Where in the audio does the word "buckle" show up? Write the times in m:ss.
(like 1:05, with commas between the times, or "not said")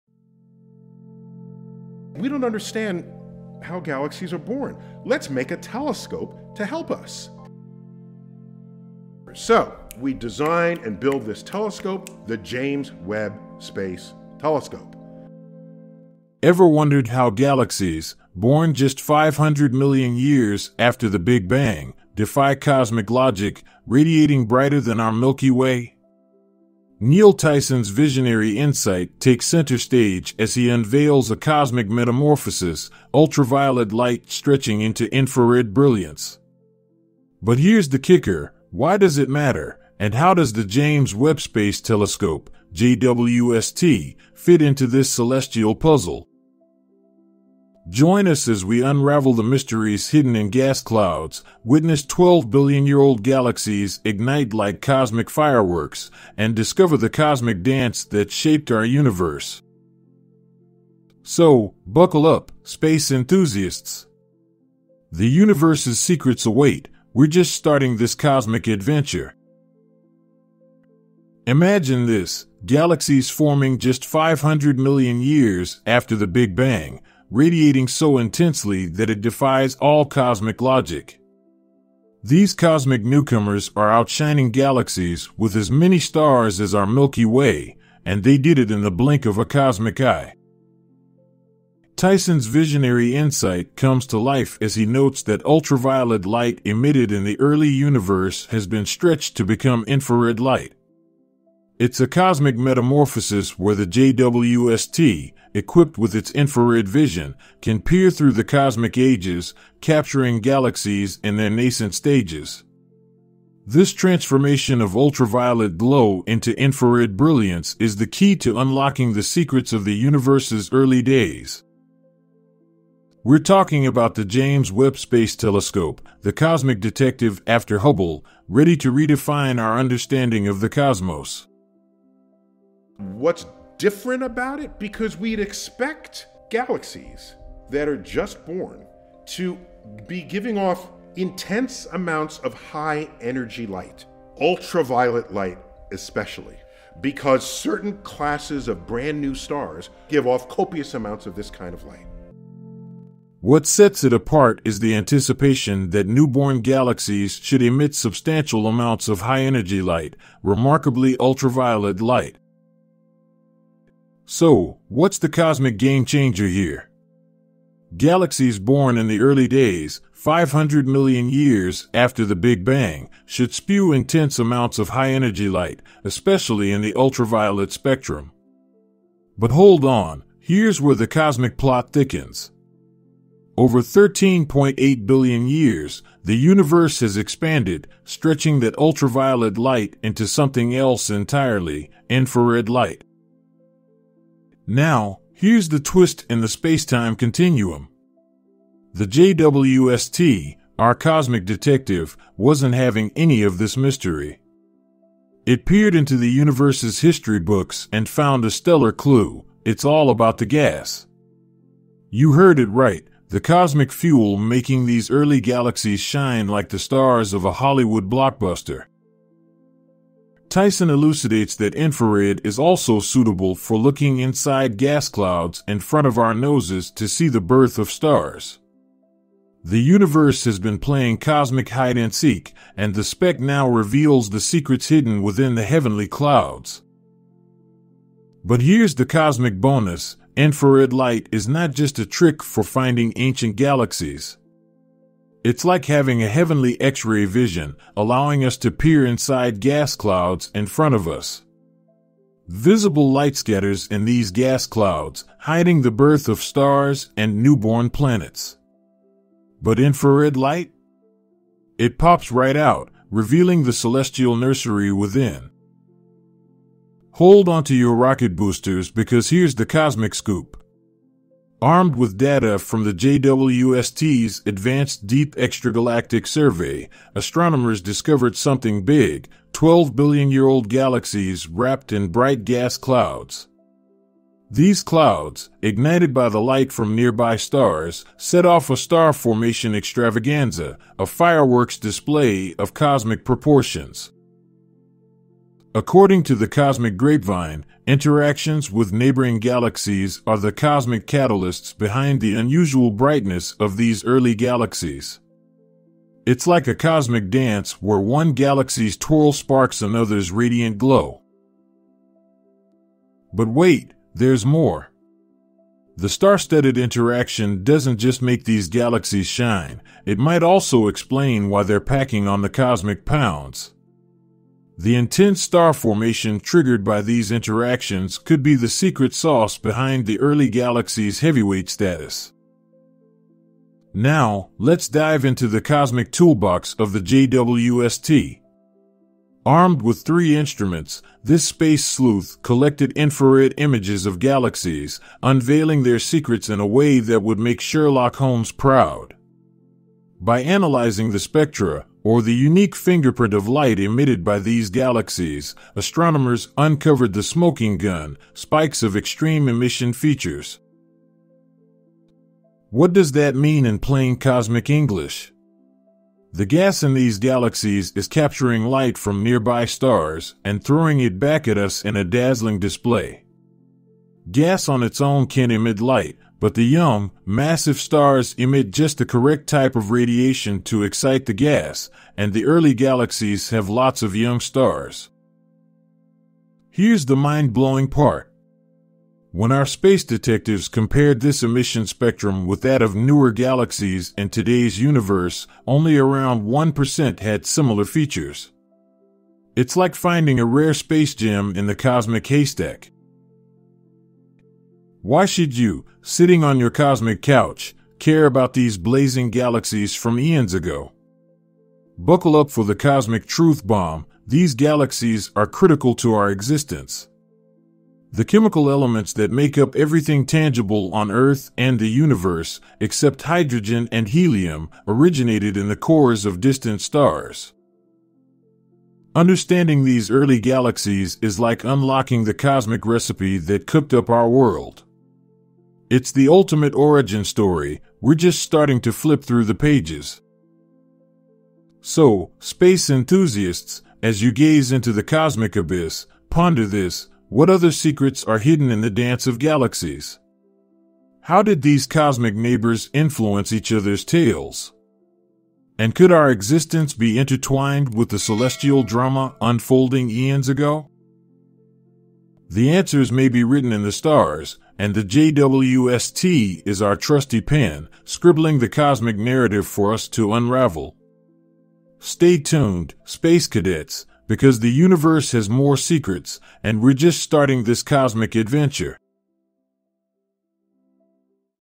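1:01, 6:51.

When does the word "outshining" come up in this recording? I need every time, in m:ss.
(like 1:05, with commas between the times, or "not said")
1:23.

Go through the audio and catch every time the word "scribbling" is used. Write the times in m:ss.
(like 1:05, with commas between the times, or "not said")
7:48.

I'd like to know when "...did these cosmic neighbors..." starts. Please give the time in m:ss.
7:31.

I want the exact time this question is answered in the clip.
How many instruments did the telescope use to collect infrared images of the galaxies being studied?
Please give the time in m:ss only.
5:40.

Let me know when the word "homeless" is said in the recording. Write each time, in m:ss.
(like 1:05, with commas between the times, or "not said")
not said.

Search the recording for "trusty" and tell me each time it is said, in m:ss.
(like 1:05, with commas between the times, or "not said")
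7:46.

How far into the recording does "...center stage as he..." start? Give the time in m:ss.
0:29.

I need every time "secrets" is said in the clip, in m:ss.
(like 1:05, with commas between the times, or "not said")
1:05, 1:59, 3:54, 5:28, 5:45, 7:27, 7:55.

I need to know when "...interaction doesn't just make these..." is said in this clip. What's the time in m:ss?
5:16.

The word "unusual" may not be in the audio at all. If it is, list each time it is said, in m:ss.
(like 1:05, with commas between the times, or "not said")
5:02.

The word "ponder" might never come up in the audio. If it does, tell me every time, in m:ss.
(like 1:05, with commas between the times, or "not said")
7:26.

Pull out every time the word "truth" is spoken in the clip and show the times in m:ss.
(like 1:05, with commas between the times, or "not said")
6:53.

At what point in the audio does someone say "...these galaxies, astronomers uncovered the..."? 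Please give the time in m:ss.
5:54.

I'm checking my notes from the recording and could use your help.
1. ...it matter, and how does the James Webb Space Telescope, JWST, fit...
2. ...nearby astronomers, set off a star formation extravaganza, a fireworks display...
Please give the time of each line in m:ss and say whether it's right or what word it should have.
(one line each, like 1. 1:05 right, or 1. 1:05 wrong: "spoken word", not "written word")
1. 0:39 right
2. 4:46 wrong: "stars", not "astronomers".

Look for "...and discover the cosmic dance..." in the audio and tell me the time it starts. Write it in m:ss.
0:56.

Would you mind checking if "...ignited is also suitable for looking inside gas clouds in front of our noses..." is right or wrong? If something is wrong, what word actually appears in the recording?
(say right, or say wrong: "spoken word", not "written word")
wrong: "infrared", not "ignited".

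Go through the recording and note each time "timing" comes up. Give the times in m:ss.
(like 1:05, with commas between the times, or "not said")
not said.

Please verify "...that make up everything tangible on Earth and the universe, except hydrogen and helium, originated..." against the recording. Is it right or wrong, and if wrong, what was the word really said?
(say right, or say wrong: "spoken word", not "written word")
right.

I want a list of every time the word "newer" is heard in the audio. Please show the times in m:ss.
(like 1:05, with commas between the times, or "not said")
6:32.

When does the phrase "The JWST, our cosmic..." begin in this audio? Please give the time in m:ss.
3:18.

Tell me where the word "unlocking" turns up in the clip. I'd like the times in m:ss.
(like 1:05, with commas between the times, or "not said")
1:58, 7:11.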